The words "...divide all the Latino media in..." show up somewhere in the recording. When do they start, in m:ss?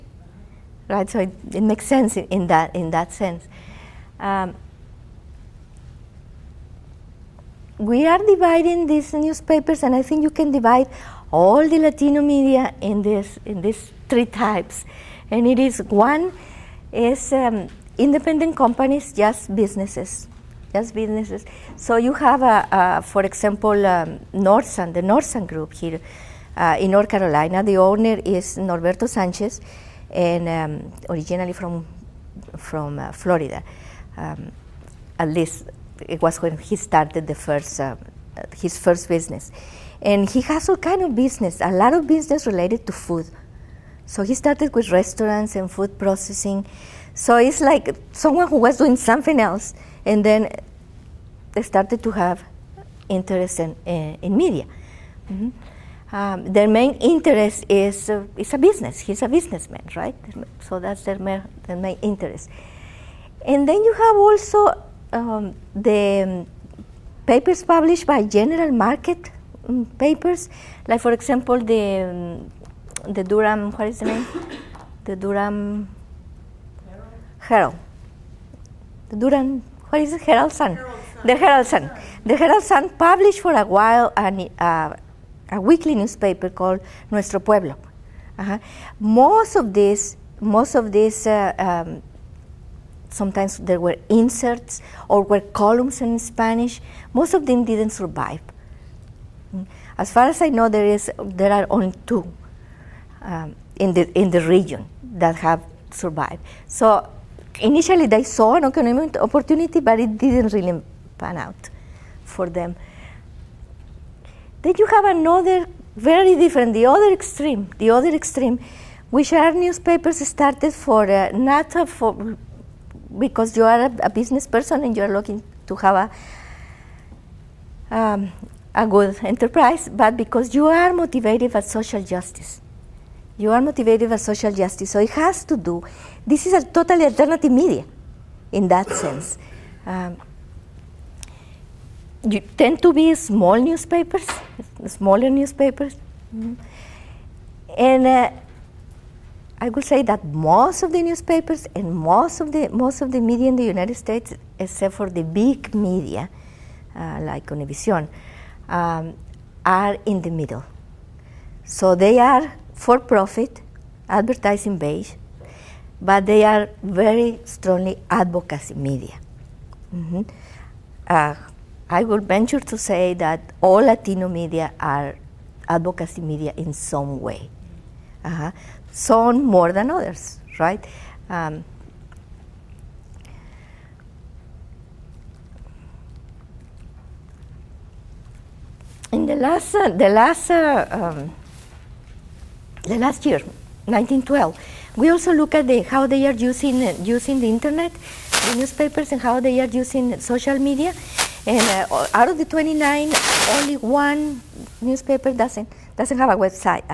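0:10.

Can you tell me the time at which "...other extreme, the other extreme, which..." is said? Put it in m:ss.
1:56.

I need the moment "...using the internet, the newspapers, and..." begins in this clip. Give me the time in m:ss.
3:17.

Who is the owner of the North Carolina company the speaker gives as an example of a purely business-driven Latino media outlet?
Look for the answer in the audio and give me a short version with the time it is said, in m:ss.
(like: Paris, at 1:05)
Norberto Sanchez, at 0:28.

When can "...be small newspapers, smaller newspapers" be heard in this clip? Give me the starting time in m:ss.
2:22.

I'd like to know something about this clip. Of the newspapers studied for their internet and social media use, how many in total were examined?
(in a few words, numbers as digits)
29.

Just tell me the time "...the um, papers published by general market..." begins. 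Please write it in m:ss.
1:05.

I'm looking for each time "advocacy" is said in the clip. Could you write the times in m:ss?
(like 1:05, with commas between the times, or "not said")
2:48, 2:55.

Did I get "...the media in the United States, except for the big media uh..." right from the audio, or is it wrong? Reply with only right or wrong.
right.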